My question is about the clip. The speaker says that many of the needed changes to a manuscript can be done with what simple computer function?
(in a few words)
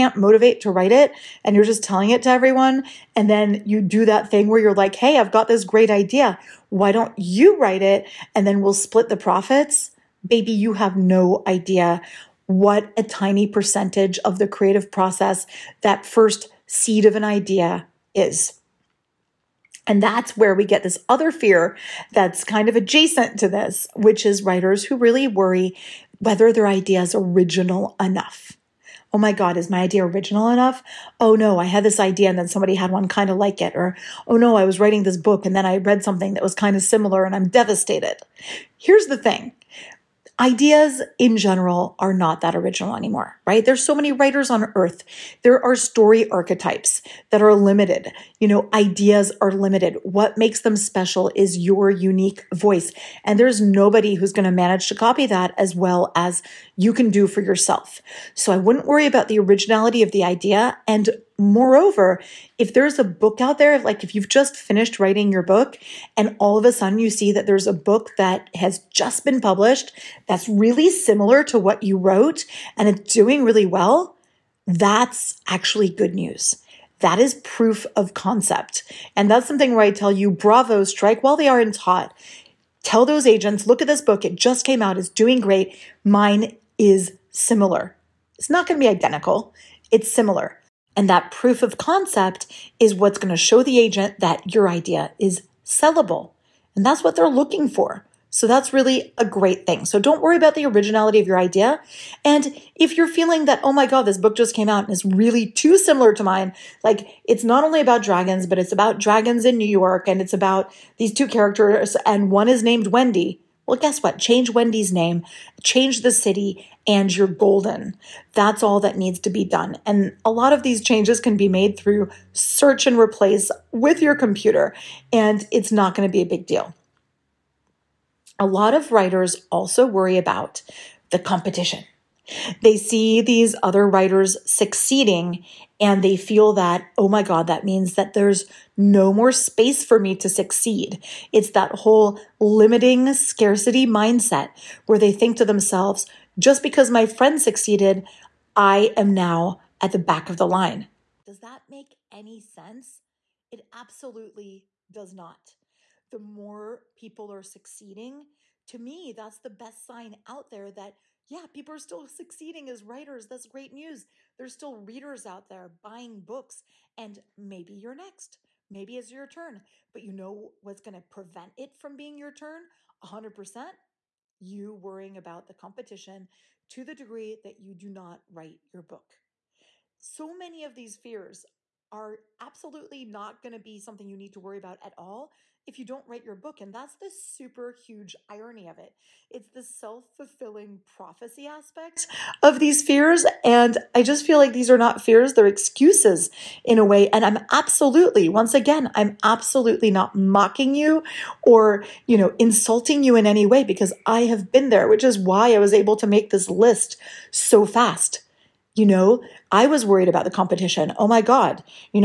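search and replace.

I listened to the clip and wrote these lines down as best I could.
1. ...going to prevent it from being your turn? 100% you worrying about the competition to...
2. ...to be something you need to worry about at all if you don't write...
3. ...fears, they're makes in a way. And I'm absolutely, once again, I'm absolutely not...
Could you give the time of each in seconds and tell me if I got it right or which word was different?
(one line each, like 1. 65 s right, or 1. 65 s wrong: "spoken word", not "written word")
1. 170 s right
2. 183 s right
3. 195 s wrong: "excuses", not "makes".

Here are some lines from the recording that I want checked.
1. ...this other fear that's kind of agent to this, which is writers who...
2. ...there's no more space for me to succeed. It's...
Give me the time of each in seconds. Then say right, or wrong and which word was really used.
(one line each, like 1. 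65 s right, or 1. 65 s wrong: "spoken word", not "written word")
1. 20 s wrong: "adjacent", not "agent"
2. 138 s right.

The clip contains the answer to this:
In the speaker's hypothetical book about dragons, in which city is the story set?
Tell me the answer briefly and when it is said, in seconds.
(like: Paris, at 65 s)
New York, at 109 s.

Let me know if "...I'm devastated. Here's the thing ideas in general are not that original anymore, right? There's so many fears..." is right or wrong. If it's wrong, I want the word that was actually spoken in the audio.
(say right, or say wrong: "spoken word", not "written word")
wrong: "writers", not "fears".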